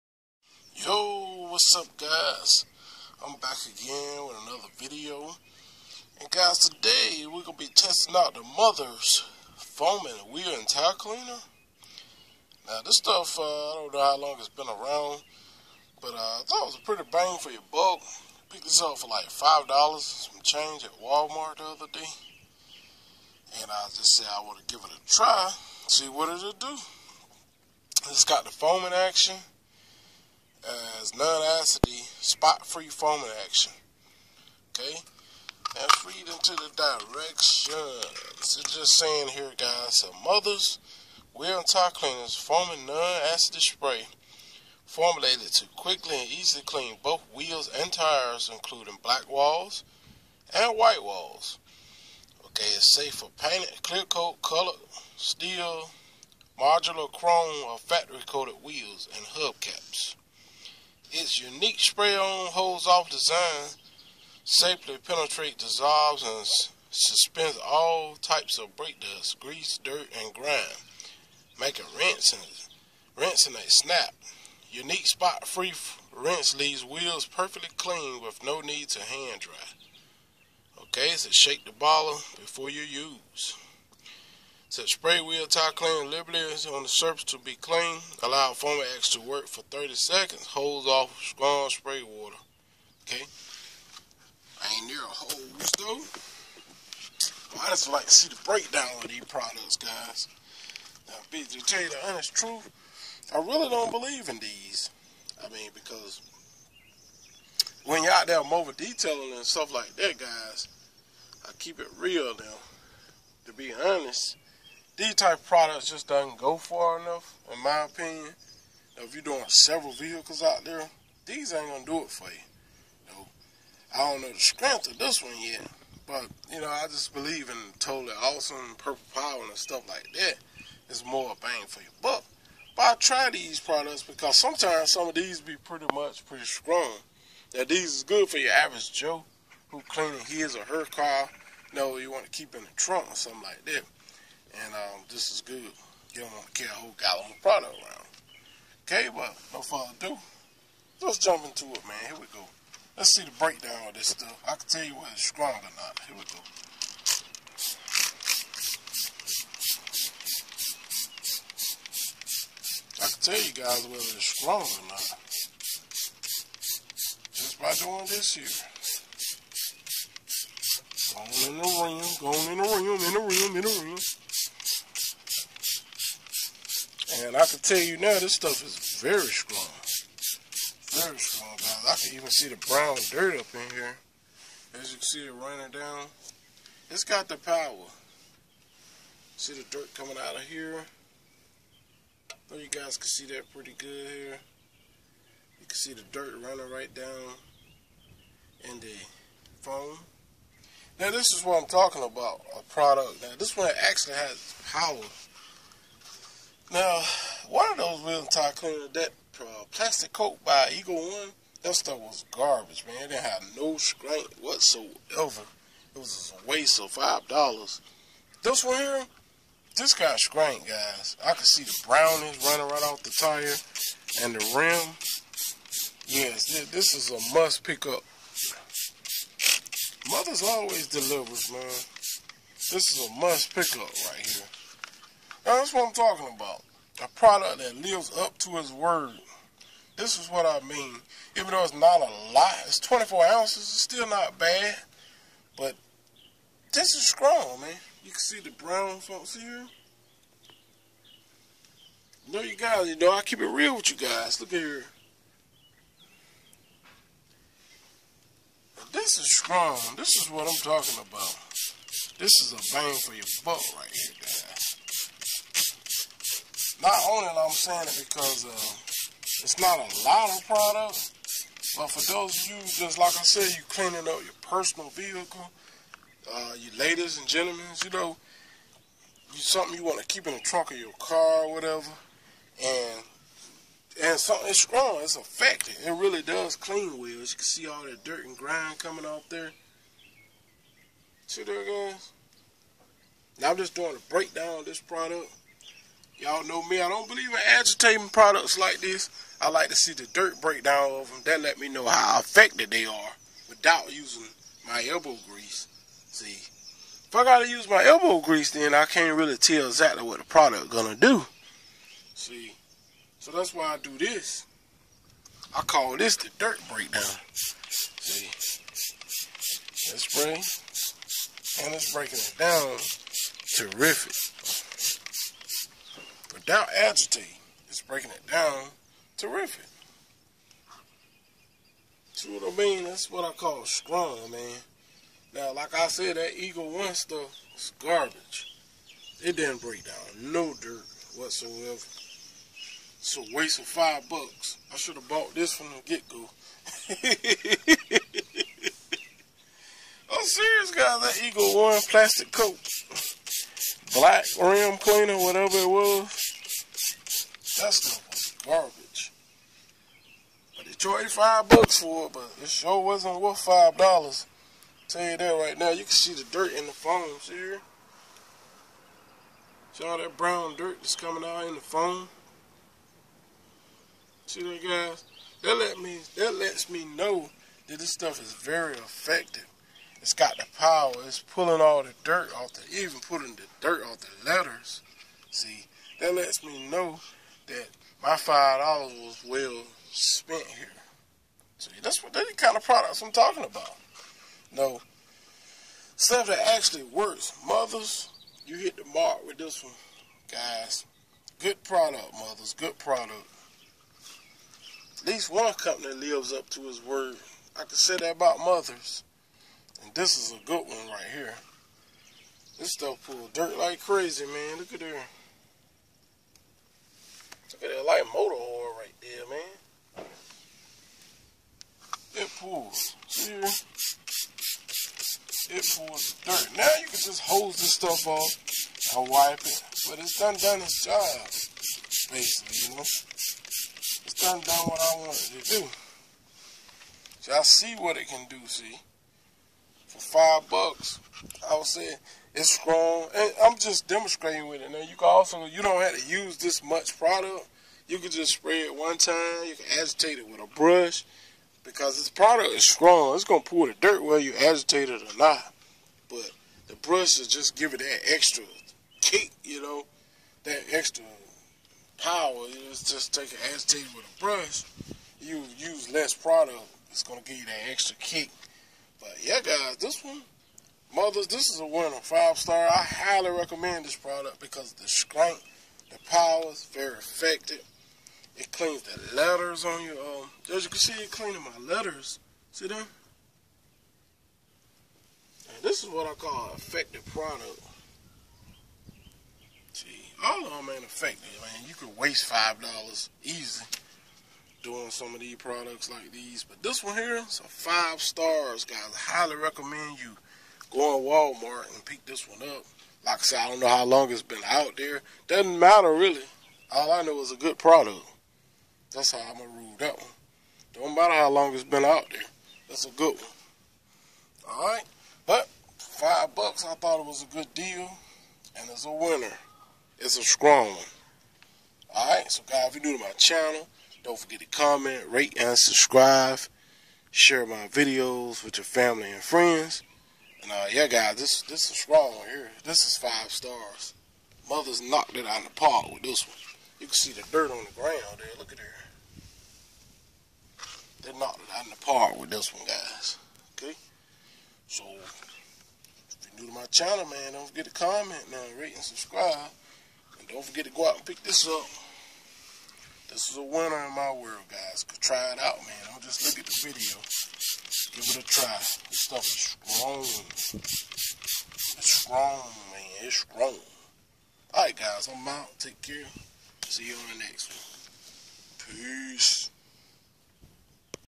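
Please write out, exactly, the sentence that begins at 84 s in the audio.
Set spray wheel tie clean liberties on the surface to be clean.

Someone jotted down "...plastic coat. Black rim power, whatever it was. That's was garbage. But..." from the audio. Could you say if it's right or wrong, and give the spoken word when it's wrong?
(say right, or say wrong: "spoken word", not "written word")
wrong: "cleaner", not "power".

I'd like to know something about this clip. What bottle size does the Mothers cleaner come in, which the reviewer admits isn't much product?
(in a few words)
24 ounces.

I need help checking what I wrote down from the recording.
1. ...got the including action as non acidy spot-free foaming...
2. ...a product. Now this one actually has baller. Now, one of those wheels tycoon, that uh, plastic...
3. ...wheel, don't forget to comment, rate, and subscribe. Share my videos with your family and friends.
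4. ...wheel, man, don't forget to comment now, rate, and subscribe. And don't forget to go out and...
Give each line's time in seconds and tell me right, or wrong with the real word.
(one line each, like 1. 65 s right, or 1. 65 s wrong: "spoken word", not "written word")
1. 28 s wrong: "foaming", not "including"
2. 202 s wrong: "power", not "baller"
3. 523 s wrong: "channel", not "wheel"
4. 546 s wrong: "channel", not "wheel".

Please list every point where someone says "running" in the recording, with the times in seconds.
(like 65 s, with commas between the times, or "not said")
185 s, 196 s, 222 s.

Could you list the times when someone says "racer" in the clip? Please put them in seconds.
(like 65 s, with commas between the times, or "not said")
not said.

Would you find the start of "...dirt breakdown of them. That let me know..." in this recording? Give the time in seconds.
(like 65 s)
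300 s.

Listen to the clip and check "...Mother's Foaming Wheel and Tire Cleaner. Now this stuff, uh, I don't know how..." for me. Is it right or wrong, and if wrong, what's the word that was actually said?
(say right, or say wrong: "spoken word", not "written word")
right.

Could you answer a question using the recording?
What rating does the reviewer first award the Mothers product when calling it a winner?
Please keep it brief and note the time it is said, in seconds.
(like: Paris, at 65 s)
5 stars, at 472 s.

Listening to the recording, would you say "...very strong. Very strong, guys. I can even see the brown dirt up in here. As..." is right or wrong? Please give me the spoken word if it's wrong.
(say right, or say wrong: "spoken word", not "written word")
right.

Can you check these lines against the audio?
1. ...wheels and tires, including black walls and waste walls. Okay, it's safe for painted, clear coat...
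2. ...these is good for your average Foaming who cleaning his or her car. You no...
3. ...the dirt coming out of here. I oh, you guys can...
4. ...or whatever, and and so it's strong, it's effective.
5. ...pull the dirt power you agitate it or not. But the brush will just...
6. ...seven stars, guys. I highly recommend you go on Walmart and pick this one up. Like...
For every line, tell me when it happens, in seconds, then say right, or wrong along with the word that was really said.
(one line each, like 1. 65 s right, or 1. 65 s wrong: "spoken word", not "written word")
1. 47 s wrong: "white", not "waste"
2. 137 s wrong: "Joe", not "Foaming"
3. 189 s right
4. 281 s right
5. 453 s wrong: "whether", not "power"
6. 497 s wrong: "five", not "seven".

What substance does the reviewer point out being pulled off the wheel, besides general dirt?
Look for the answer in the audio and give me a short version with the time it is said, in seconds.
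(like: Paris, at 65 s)
light motor oil, at 417 s.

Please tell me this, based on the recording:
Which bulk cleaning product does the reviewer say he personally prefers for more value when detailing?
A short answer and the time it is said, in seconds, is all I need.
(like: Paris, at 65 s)
Purple Power, at 128 s.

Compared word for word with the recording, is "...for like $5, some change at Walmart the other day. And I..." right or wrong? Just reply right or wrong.
right.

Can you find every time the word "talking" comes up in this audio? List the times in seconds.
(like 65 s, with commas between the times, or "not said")
201 s, 235 s, 260 s, 393 s.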